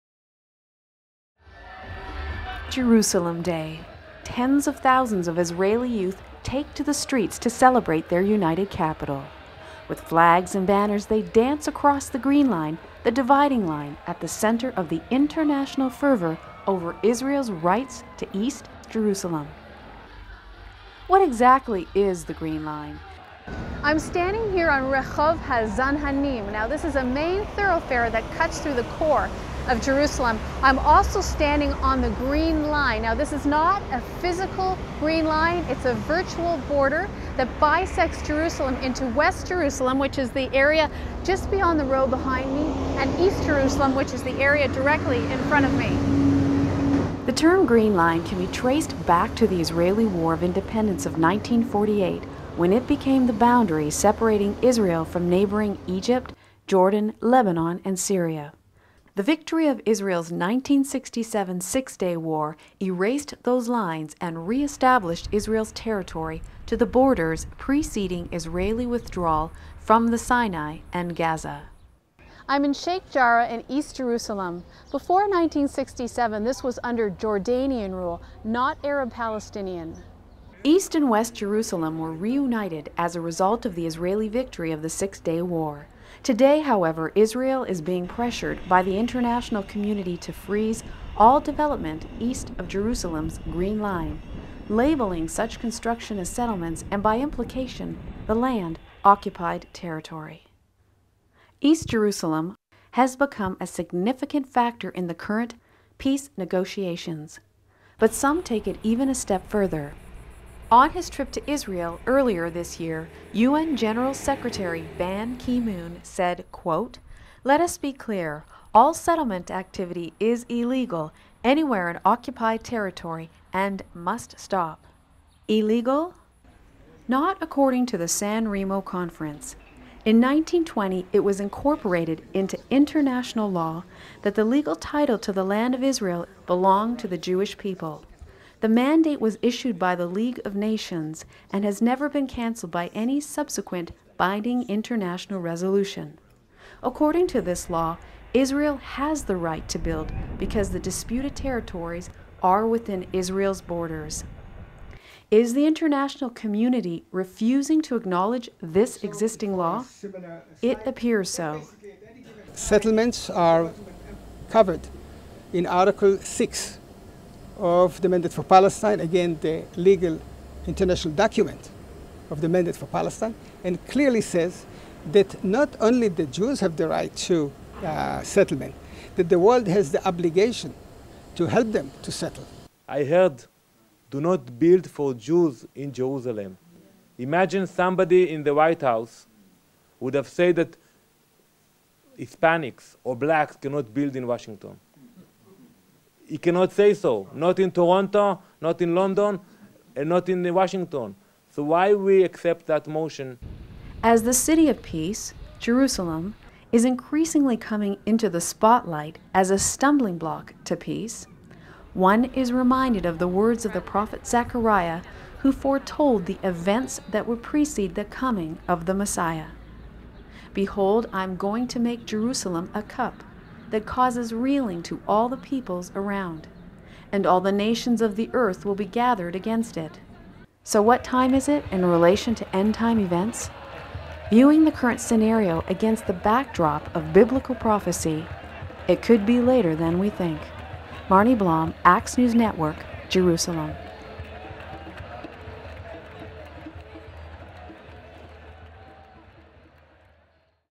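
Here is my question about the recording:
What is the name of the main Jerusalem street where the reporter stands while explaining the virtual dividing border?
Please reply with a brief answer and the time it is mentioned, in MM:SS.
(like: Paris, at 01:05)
Rehov Hazan Hanim, at 00:24.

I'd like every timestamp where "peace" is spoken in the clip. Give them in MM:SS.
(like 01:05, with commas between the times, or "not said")
01:45, 03:24, 03:30.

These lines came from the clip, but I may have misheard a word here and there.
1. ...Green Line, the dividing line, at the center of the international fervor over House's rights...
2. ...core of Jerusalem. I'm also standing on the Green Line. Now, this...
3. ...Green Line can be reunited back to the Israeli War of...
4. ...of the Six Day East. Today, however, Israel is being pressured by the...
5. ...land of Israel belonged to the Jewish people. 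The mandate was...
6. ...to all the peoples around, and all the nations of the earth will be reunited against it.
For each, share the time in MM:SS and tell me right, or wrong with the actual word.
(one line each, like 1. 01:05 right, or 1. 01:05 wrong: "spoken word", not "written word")
1. 00:12 wrong: "Israel", not "House"
2. 00:28 right
3. 00:47 wrong: "traced", not "reunited"
4. 01:24 wrong: "War", not "East"
5. 02:15 right
6. 03:44 wrong: "gathered", not "reunited".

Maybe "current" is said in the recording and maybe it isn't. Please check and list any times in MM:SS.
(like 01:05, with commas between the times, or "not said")
01:45, 03:54.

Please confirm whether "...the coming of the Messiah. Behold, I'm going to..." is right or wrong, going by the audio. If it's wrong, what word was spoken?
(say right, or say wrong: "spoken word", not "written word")
right.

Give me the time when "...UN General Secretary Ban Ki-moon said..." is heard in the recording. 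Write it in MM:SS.
01:53.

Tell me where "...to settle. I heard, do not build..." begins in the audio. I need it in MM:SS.
03:02.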